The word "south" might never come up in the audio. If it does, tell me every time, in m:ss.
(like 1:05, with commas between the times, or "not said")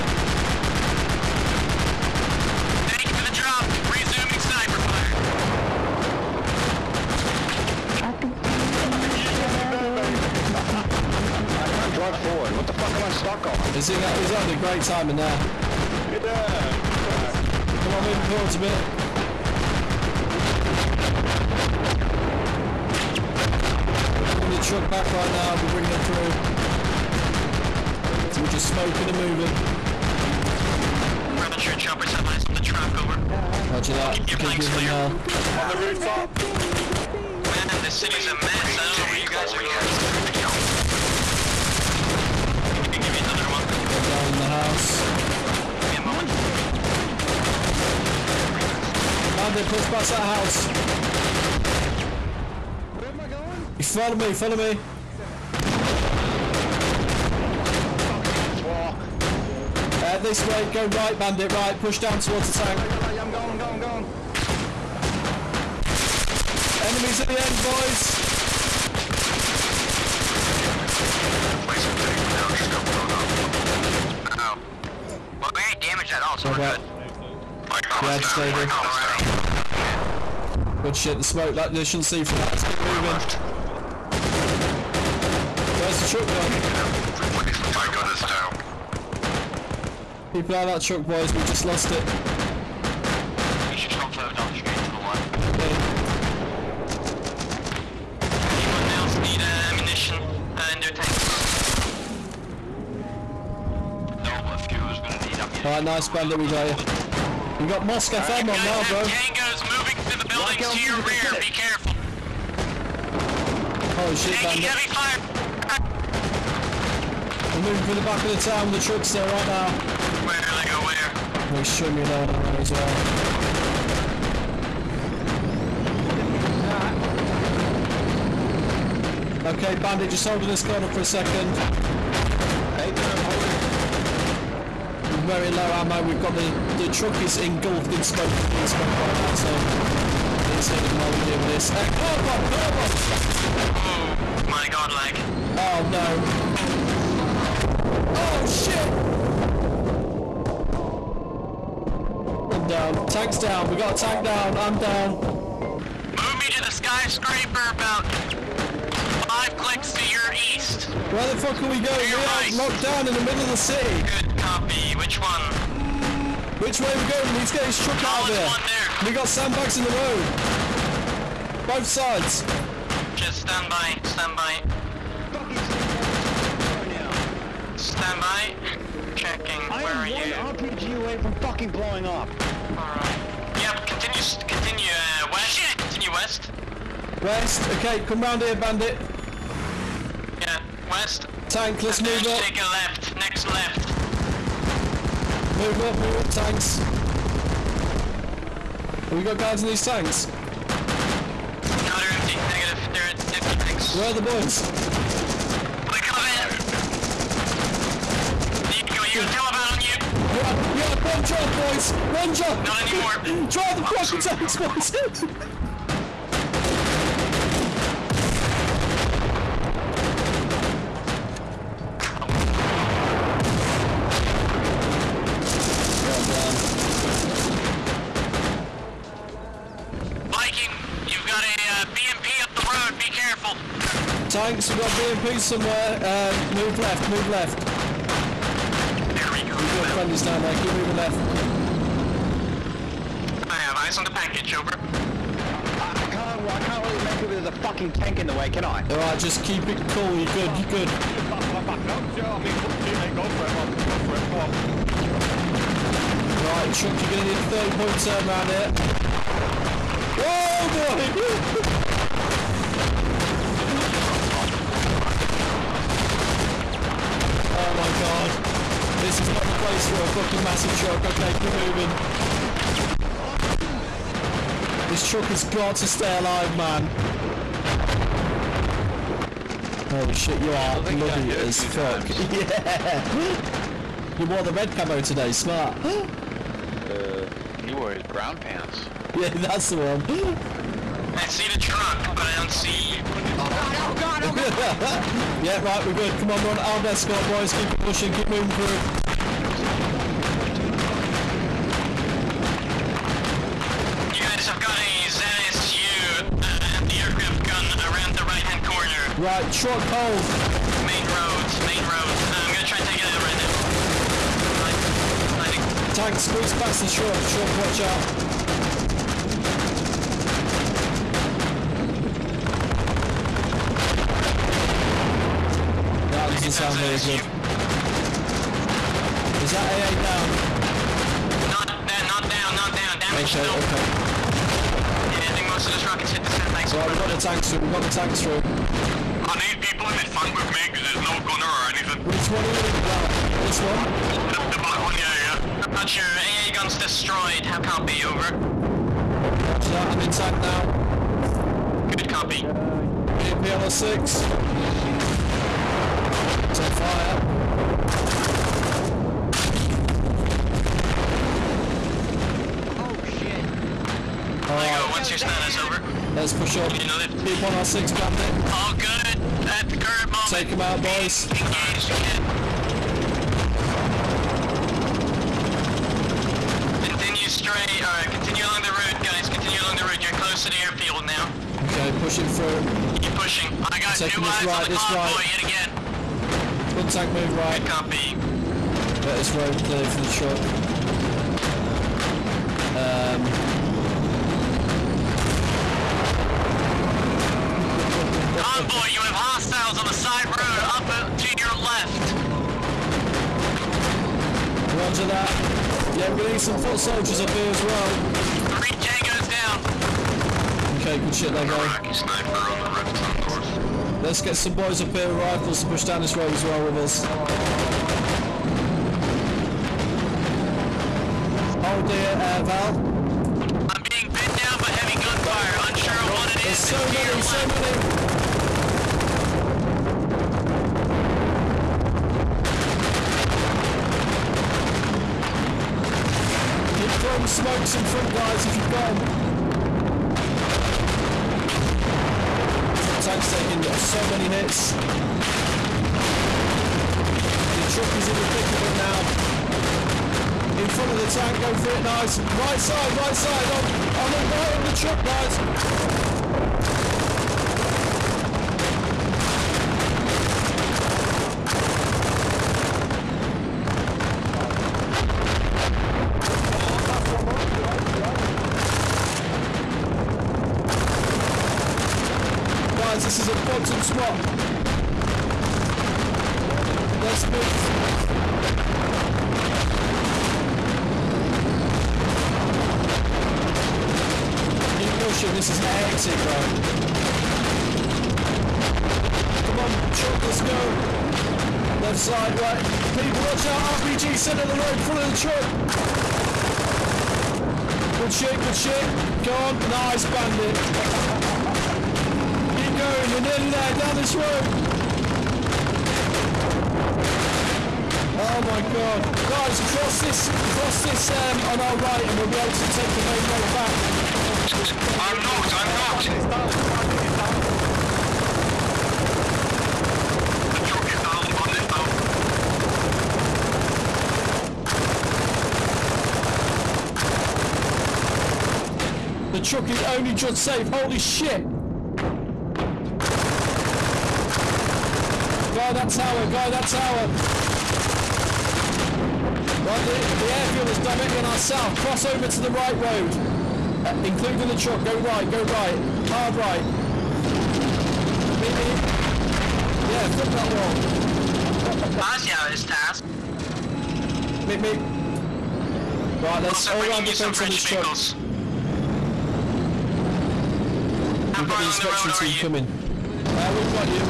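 9:01.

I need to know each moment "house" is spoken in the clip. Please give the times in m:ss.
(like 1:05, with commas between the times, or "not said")
0:44, 0:50.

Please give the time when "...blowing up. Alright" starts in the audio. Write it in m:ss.
3:01.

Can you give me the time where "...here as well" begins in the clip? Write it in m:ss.
6:47.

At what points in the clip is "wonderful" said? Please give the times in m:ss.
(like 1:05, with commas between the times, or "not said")
not said.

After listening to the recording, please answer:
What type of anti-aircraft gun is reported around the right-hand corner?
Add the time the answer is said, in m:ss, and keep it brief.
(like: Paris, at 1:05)
ZSU, at 5:05.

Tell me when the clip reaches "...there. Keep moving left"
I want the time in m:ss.
4:00.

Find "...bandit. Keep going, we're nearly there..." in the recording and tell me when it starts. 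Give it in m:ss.
8:20.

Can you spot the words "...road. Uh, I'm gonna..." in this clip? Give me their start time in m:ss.
5:11.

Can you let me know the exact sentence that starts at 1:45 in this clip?
Alright, nice bandit, we got you.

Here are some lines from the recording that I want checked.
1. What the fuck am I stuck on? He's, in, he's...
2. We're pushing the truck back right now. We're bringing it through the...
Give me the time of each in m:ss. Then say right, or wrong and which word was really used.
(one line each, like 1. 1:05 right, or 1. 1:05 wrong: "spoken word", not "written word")
1. 0:12 right
2. 0:24 wrong: "bringing", not "pushing".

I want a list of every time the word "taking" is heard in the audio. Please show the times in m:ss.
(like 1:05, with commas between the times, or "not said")
1:54, 7:23.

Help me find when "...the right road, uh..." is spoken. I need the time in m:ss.
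9:02.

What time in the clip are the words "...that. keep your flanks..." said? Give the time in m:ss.
0:33.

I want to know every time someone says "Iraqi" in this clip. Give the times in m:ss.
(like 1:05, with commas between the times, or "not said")
6:51.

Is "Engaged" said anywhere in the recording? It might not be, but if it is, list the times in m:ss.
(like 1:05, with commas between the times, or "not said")
6:11.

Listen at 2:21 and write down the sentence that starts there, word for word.
Uh, eh, car bomb, car bomb!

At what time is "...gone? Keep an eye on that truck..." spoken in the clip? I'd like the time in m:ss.
1:26.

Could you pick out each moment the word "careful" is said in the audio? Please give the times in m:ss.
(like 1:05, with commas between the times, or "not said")
1:51, 3:53.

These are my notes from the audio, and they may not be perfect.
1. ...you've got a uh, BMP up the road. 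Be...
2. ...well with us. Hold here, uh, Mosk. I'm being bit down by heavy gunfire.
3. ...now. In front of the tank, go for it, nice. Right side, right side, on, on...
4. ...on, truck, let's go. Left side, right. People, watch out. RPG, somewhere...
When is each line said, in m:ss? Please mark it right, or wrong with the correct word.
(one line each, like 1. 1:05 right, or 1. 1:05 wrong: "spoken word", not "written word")
1. 3:51 right
2. 6:56 wrong: "Val", not "Mosk"
3. 7:28 right
4. 8:09 wrong: "centre", not "somewhere".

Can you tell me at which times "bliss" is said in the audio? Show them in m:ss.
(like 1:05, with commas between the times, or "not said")
not said.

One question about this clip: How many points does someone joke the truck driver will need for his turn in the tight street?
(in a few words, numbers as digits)
30.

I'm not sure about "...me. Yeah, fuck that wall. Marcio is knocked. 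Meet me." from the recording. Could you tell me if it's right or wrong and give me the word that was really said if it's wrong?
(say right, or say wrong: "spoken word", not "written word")
wrong: "tasked", not "knocked".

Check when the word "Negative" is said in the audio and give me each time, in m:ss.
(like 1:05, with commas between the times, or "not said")
3:22.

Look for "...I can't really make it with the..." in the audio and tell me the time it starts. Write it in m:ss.
4:06.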